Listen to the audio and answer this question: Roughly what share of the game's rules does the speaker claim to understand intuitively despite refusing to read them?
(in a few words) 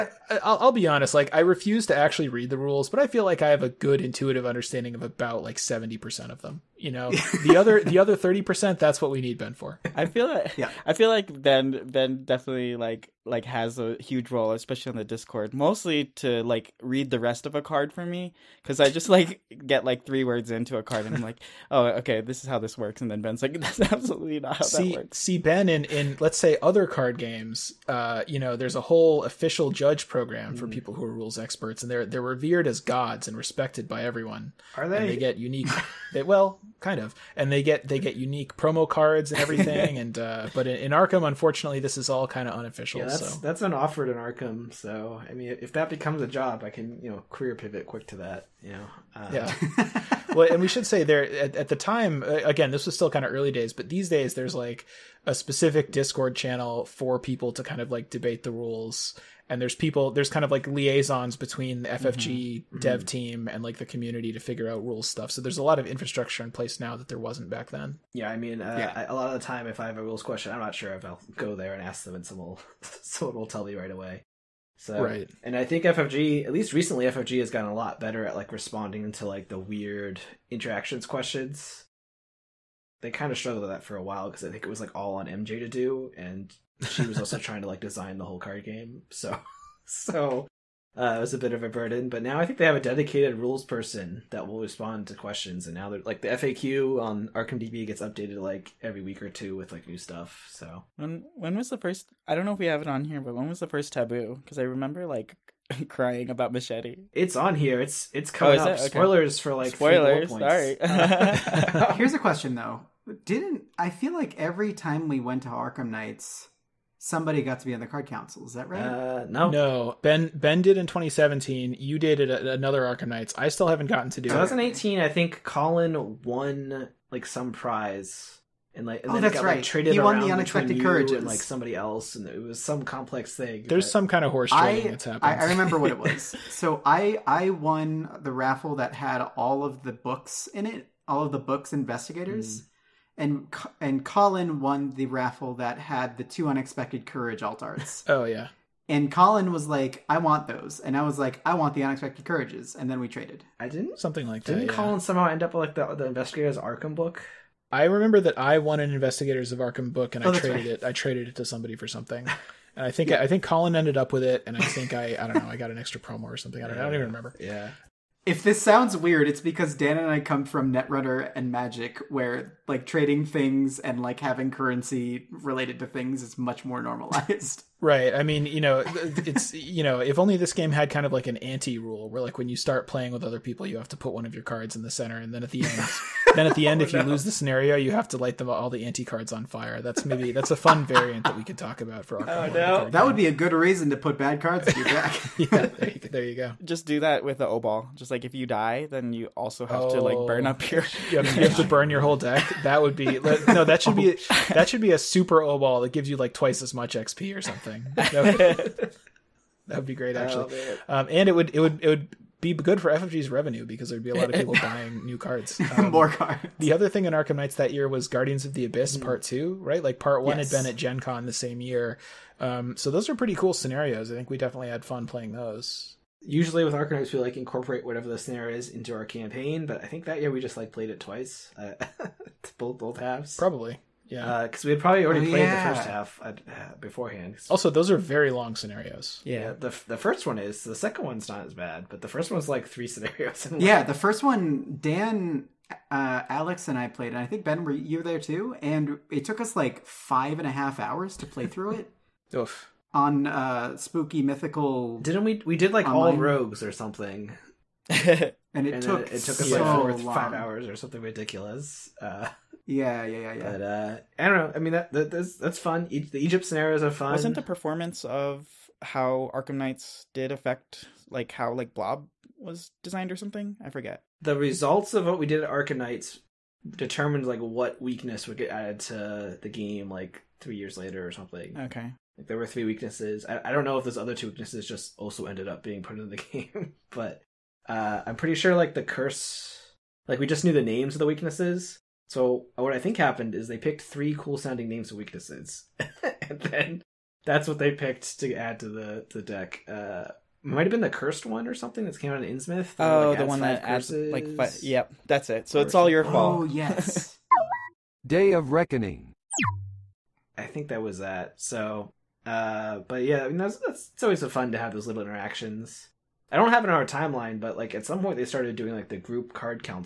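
70 percent.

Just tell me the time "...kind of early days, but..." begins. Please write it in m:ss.
0:53.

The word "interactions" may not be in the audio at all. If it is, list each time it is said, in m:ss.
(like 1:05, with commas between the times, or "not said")
1:20, 5:15.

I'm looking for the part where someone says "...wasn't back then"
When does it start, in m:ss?
1:07.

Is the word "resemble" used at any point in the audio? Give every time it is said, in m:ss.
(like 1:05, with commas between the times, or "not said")
not said.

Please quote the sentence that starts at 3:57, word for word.
Also, those are very long scenarios.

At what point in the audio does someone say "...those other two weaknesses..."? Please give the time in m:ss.
4:43.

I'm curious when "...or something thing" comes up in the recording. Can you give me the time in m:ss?
3:27.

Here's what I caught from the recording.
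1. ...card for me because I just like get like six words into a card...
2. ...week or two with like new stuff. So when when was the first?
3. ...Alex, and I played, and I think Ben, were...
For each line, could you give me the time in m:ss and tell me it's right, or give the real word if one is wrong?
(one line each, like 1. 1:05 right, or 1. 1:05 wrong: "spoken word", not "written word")
1. 0:17 wrong: "three", not "six"
2. 1:39 right
3. 4:06 right.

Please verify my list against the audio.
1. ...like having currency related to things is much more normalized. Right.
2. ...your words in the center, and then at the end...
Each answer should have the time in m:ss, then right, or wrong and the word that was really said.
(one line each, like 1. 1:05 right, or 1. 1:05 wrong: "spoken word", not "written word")
1. 2:54 right
2. 3:04 wrong: "cards", not "words".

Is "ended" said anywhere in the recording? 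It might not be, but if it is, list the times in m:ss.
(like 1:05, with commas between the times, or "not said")
2:43, 4:45.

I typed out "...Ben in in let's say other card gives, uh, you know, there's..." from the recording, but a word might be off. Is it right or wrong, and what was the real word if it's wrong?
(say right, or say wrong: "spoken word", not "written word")
wrong: "games", not "gives".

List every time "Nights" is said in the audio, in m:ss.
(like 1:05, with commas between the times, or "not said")
1:55, 2:03, 3:37, 3:46, 4:29, 4:35.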